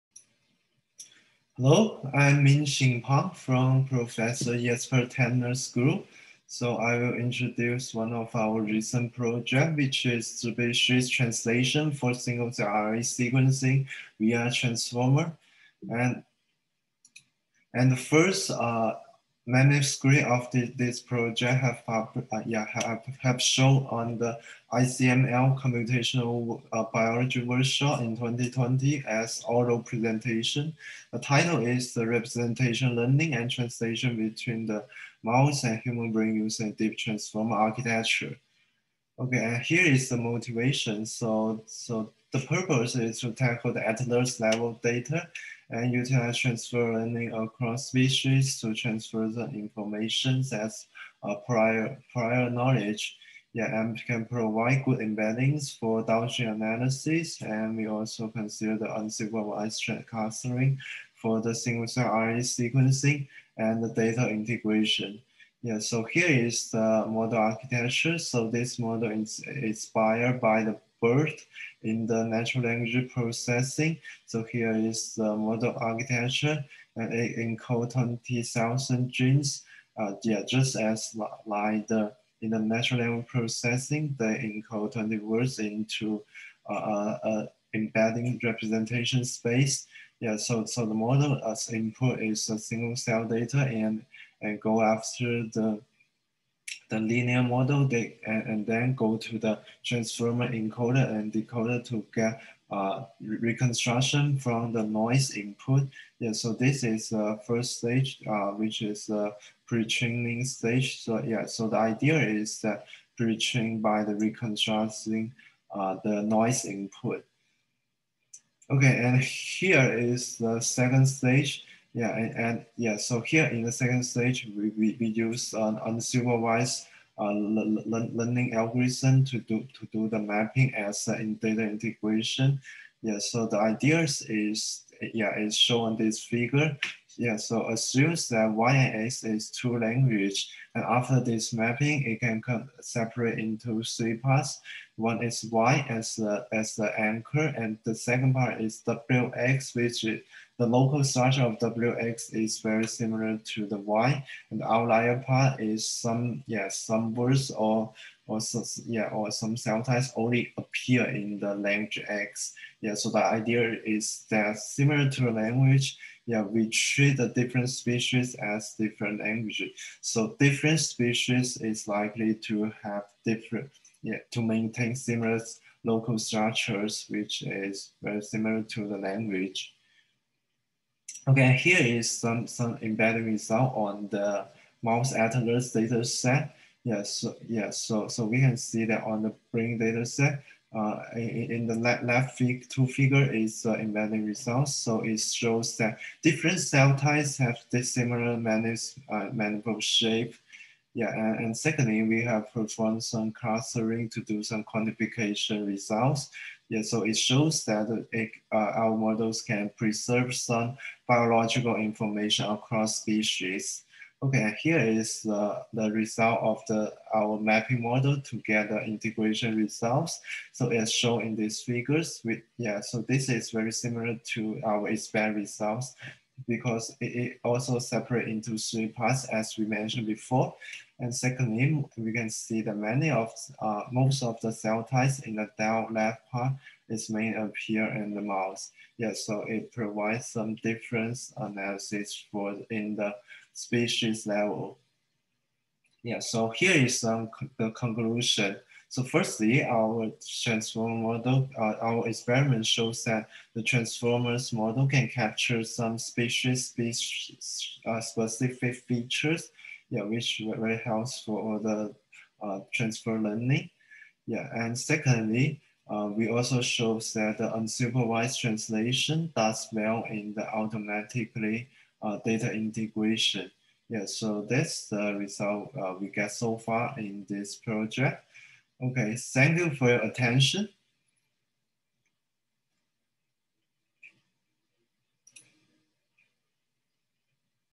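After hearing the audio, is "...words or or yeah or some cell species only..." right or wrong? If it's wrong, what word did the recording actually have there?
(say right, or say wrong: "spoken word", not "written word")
wrong: "types", not "species".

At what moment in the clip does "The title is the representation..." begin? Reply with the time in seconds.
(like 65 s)
31 s.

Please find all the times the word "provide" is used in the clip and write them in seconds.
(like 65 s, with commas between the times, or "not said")
54 s, 239 s.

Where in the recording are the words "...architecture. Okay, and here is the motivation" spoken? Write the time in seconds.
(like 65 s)
37 s.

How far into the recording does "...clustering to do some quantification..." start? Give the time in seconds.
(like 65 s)
203 s.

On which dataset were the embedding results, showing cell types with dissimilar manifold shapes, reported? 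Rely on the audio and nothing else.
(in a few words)
mouse atlas.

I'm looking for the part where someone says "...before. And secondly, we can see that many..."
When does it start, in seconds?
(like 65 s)
230 s.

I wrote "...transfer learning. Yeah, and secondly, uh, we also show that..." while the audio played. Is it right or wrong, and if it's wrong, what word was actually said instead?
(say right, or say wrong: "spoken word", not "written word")
right.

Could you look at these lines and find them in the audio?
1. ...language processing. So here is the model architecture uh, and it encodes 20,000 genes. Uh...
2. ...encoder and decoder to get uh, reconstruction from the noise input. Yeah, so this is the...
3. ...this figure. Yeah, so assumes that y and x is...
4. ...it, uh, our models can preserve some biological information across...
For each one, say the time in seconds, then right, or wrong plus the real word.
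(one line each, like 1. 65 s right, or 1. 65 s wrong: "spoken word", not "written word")
1. 72 s right
2. 100 s right
3. 136 s right
4. 208 s right.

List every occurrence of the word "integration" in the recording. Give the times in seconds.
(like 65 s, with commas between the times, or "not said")
64 s, 131 s, 218 s, 272 s.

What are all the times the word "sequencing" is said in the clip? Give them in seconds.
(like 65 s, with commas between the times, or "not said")
13 s, 62 s.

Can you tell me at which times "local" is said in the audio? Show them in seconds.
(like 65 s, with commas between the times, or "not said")
150 s, 175 s.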